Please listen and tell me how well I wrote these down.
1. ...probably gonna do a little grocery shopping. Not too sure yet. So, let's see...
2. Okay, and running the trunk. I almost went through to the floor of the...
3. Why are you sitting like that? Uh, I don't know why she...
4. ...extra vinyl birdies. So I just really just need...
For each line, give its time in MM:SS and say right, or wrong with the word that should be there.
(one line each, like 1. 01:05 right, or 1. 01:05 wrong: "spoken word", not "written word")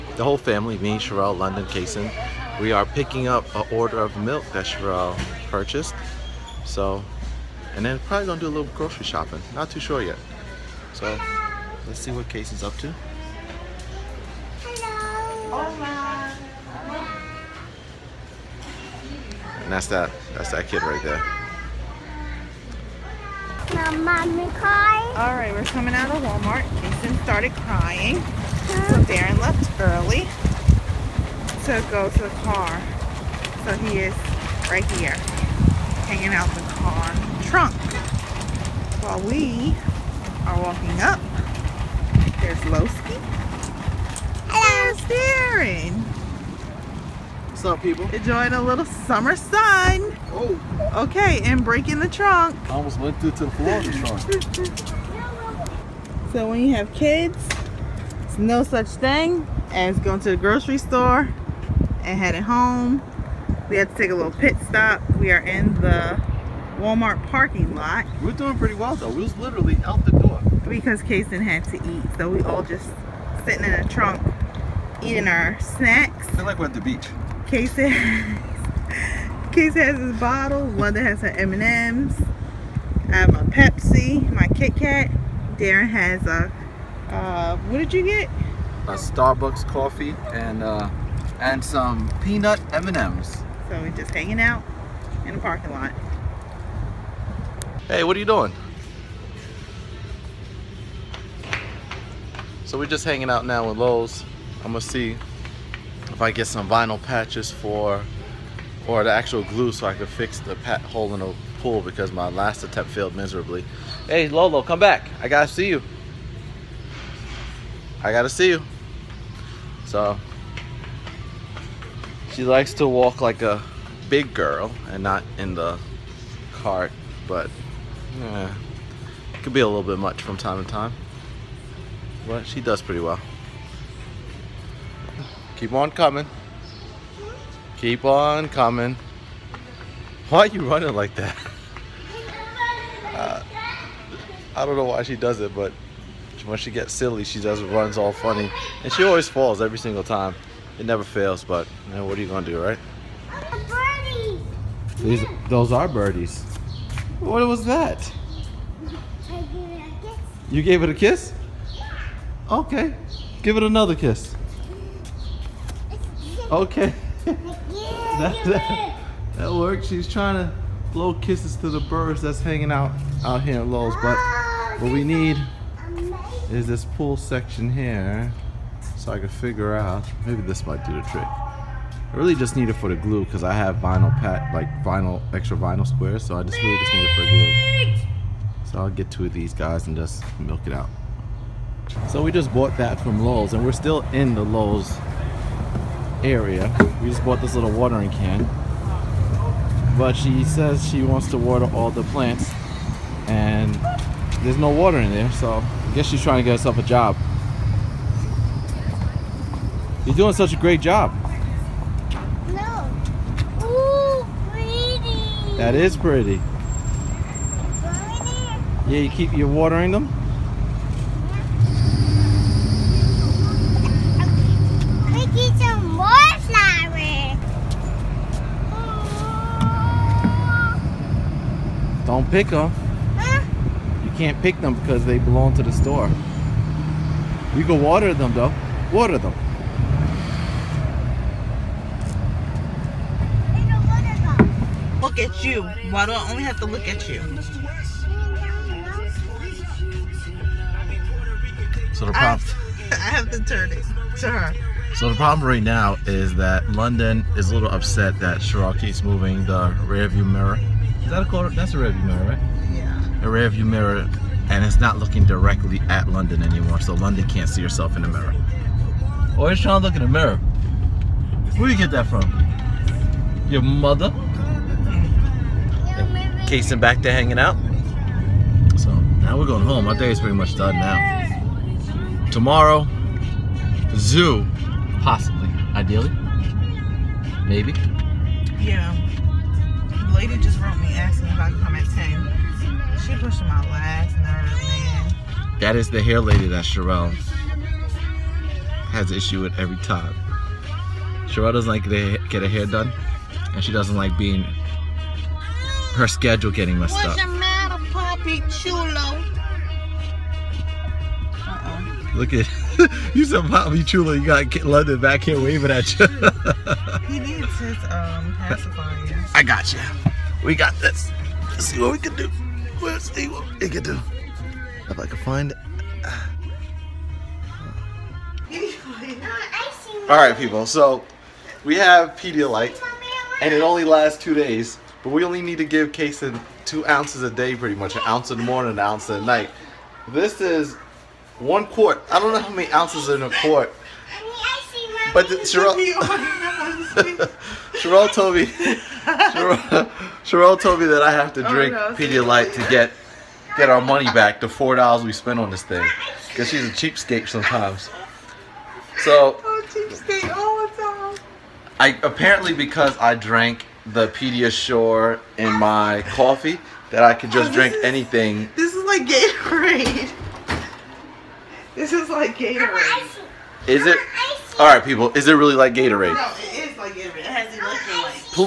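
1. 00:08 right
2. 00:51 wrong: "breaking", not "running"
3. 02:20 wrong: "running", not "sitting"
4. 03:05 wrong: "squares", not "birdies".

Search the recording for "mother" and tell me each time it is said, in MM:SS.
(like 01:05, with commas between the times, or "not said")
04:33.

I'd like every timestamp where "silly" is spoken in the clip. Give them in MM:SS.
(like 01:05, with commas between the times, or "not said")
02:26.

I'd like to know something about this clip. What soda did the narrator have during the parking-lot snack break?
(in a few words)
Pepsi.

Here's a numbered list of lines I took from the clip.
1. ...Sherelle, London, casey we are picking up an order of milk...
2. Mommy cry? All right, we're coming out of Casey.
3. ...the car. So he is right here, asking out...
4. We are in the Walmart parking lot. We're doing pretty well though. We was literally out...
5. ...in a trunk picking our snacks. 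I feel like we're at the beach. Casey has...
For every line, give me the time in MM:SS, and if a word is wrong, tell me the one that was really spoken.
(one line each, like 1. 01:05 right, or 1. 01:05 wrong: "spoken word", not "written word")
1. 00:00 right
2. 00:24 wrong: "Walmart", not "Casey"
3. 00:32 wrong: "hanging", not "asking"
4. 01:05 right
5. 01:13 wrong: "eating", not "picking".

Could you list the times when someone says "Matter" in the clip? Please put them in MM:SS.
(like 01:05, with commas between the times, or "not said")
05:07.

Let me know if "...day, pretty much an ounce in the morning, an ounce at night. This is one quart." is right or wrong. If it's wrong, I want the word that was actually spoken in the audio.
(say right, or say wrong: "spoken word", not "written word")
right.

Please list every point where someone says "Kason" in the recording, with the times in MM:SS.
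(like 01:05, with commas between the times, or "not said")
01:11, 05:35.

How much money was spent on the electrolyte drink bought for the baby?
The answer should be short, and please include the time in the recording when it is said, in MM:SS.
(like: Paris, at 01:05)
$4, at 05:54.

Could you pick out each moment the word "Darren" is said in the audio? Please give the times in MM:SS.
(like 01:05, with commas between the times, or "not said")
00:29, 00:45, 01:25.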